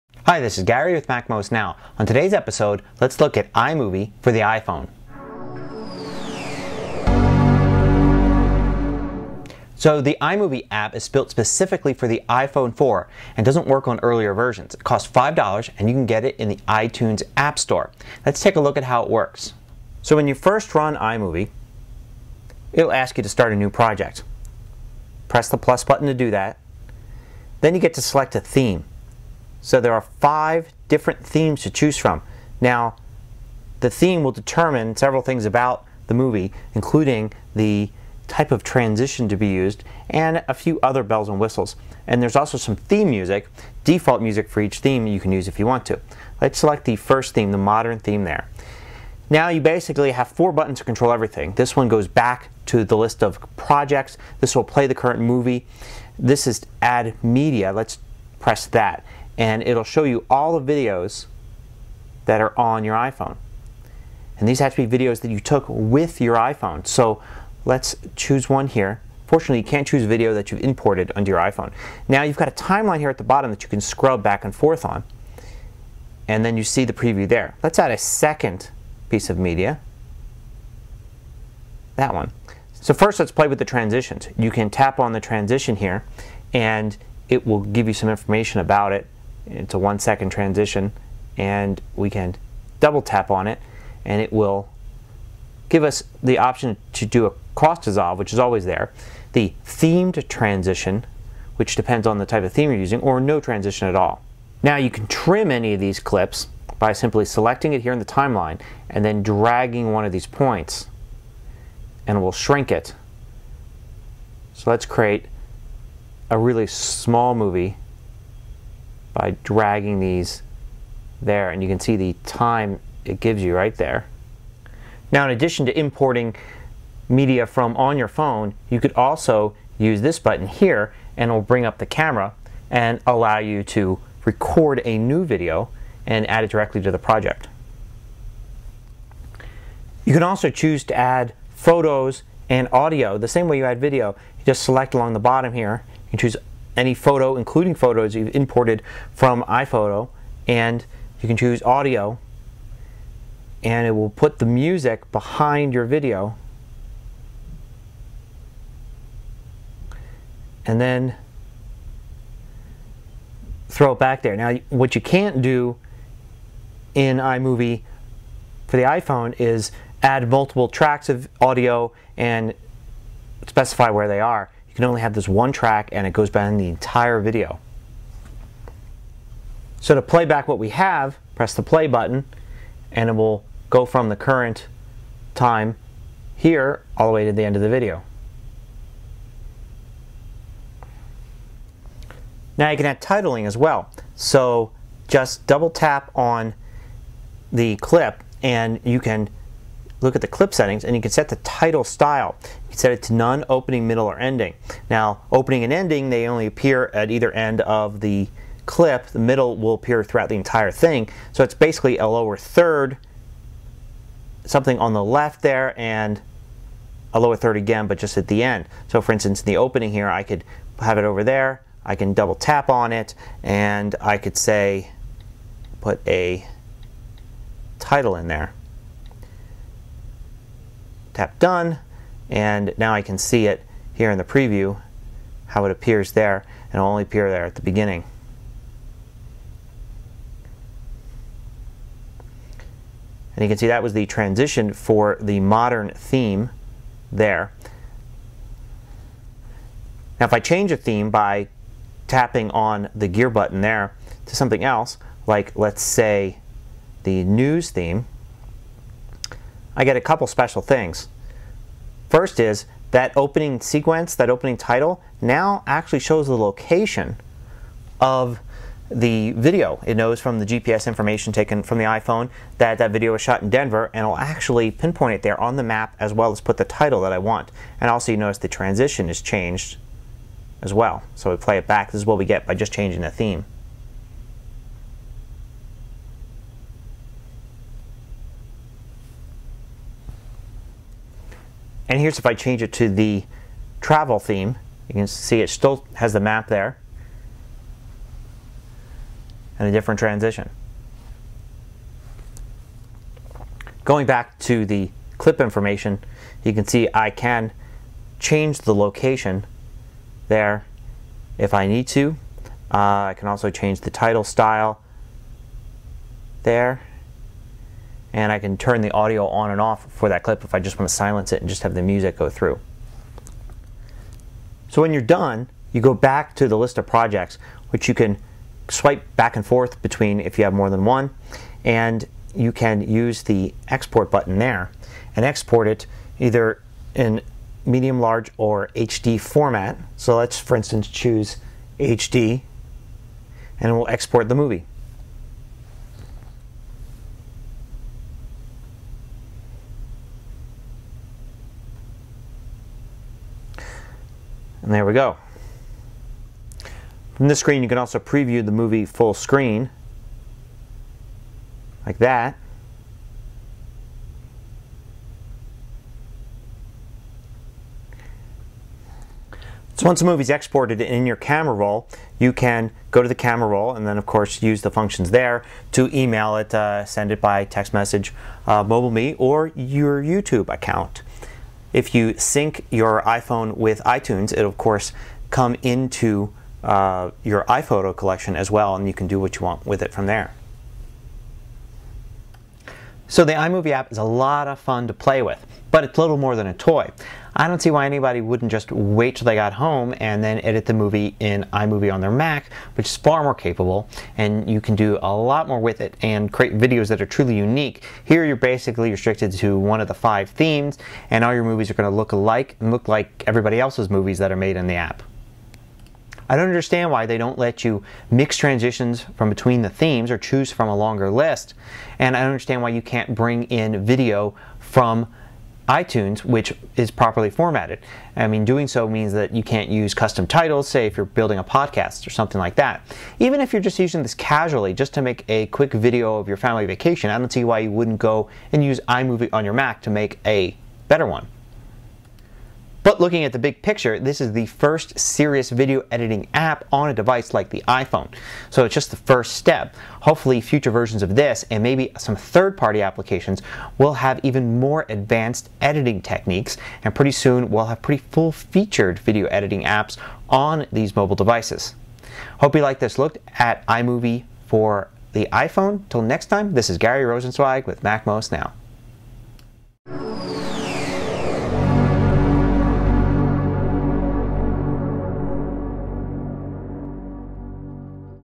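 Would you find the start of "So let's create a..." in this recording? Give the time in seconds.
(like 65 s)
114 s.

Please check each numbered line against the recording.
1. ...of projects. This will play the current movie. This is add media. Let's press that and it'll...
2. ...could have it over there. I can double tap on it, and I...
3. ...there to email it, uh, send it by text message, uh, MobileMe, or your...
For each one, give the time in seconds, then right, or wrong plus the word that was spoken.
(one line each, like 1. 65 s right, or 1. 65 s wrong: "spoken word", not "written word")
1. 53 s right
2. 220 s right
3. 375 s right.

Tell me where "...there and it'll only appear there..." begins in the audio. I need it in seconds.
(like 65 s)
236 s.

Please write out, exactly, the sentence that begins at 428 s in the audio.
I mean, doing so means that you can't use custom titles, say if you're building a podcast or something like that.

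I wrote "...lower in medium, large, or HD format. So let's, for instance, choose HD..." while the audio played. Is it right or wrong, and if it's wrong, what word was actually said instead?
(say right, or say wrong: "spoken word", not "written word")
wrong: "either", not "lower".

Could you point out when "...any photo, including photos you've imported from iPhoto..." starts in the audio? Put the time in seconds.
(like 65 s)
146 s.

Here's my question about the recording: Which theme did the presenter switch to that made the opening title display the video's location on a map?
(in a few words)
news theme.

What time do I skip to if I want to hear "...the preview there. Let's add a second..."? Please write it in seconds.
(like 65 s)
76 s.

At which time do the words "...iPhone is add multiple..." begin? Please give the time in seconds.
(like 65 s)
168 s.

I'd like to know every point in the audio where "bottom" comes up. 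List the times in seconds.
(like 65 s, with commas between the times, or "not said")
73 s, 145 s.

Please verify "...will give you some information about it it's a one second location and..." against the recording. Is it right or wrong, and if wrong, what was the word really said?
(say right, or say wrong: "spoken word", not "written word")
wrong: "transition", not "location".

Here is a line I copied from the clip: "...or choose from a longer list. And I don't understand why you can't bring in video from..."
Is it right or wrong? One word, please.
right.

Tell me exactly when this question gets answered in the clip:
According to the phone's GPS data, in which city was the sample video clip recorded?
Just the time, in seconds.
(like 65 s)
273 s.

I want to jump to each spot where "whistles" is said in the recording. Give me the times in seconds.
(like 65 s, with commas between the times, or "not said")
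41 s.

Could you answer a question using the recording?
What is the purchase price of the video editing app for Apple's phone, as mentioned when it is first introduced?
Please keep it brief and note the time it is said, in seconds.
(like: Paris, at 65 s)
$5, at 15 s.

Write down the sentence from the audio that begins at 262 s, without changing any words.
First is that opening sequence, that opening title, now actually shows the location of the video.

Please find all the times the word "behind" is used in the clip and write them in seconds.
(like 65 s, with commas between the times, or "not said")
155 s, 176 s.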